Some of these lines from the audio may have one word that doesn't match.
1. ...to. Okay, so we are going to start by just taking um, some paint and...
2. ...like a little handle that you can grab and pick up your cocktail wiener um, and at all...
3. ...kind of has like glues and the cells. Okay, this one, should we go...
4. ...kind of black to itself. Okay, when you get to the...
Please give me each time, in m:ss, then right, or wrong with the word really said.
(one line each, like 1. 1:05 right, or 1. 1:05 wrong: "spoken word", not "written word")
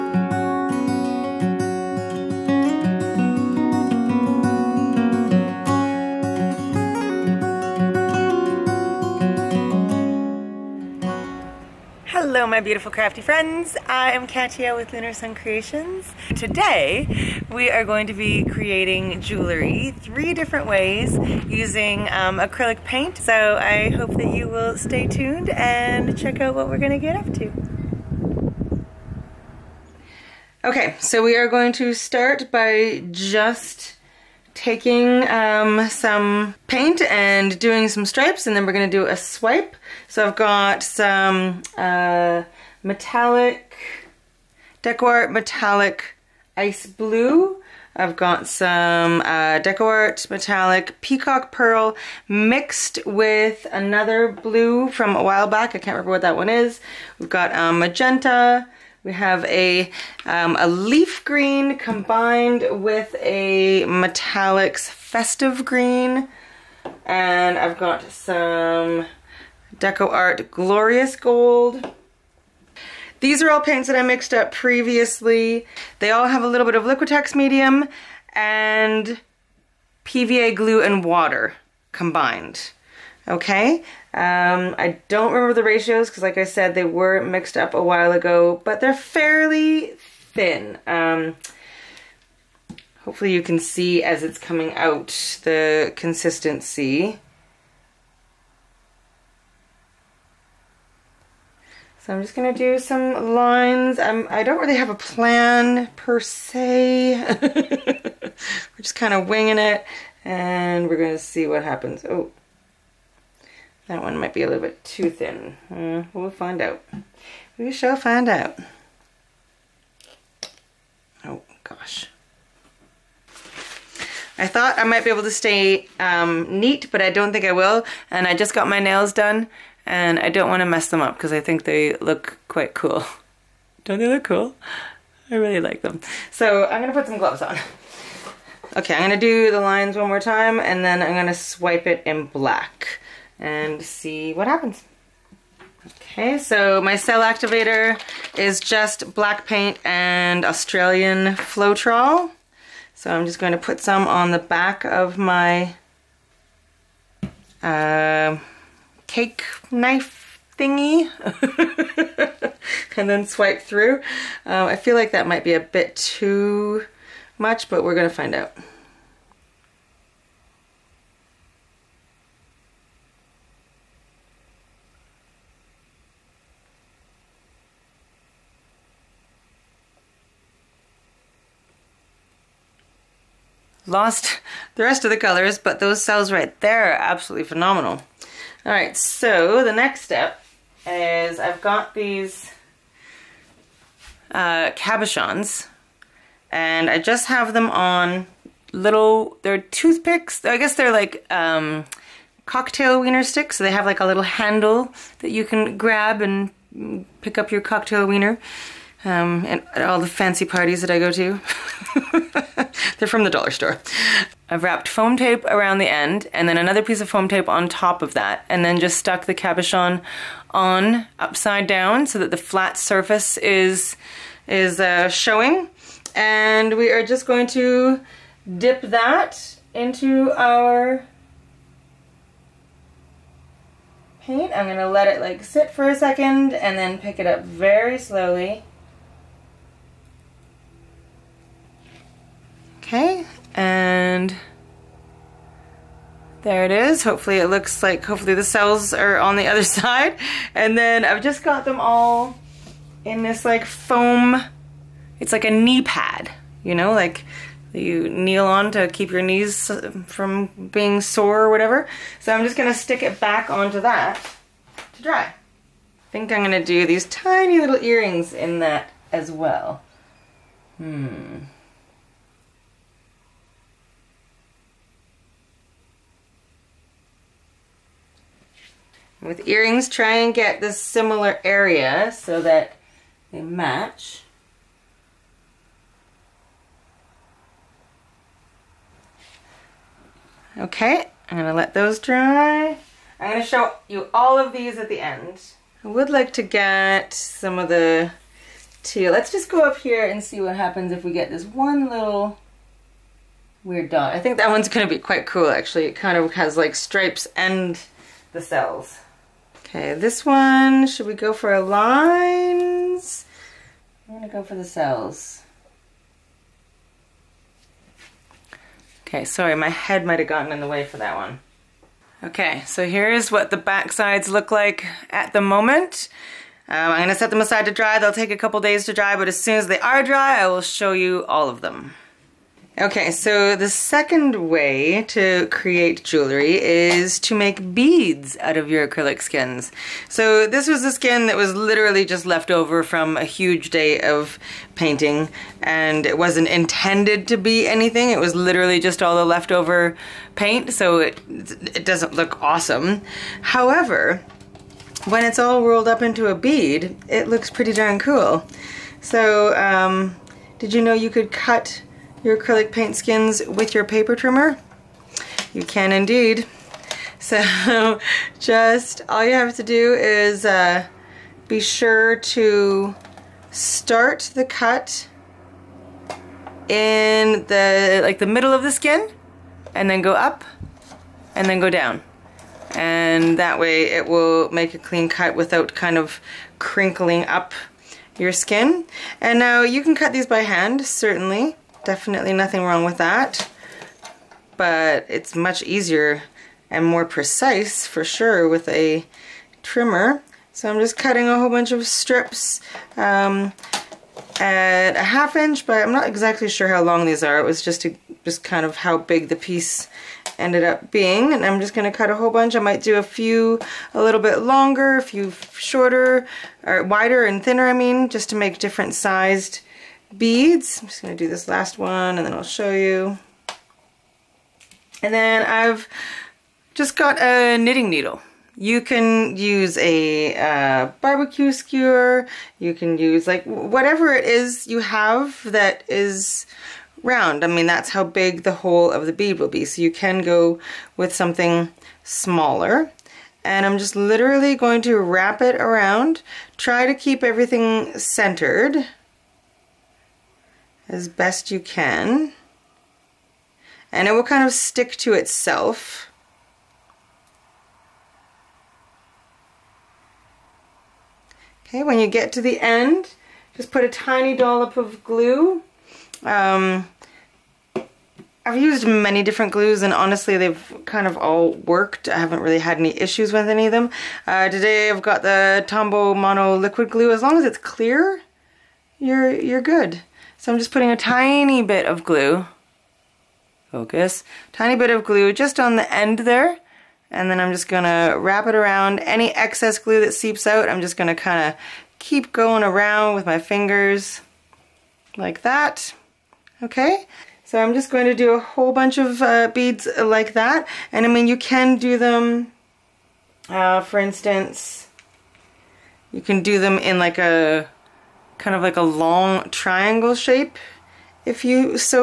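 1. 0:27 right
2. 3:23 right
3. 5:05 wrong: "stripes", not "glues"
4. 7:34 wrong: "stick", not "black".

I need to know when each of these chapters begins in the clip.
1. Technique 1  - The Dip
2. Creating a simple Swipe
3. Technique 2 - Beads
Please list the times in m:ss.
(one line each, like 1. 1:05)
1. 3:10
2. 0:29
3. 5:32.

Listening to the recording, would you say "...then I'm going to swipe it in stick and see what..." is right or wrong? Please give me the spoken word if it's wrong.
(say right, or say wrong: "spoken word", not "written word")
wrong: "black", not "stick".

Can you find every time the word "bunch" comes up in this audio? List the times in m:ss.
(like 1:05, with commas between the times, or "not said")
6:41, 6:52, 8:18.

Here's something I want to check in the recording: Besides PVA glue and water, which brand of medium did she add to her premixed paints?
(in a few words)
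Liquitex.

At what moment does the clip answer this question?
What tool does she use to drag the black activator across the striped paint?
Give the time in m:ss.
2:39.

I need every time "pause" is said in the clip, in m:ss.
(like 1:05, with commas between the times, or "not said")
not said.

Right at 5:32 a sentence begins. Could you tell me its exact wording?
Okay, so the second way to create jewelry is to make beads out of your acrylic skins.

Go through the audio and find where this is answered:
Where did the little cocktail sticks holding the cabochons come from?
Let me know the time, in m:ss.
3:33.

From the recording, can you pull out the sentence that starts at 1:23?
Okay, um, I don't remember the ratios because like I said, they were mixed up a while ago, but they're fairly thin.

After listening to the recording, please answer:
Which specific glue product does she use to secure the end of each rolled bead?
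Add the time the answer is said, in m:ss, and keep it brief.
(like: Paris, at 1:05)
Tombow Mono Liquid Glue, at 7:55.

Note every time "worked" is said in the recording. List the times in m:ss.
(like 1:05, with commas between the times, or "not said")
7:51.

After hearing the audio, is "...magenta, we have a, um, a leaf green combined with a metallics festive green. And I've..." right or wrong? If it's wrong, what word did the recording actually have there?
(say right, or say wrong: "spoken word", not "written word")
right.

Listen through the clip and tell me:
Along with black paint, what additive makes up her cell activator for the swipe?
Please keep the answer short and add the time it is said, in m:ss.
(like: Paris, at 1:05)
Australian Floetrol, at 2:30.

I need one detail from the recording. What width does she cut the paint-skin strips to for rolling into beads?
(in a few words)
half inch.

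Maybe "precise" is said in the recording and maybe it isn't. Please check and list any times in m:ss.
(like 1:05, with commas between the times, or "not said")
6:37.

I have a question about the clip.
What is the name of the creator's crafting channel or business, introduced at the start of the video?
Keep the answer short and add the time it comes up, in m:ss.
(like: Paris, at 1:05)
Lunar Sun Creations, at 0:14.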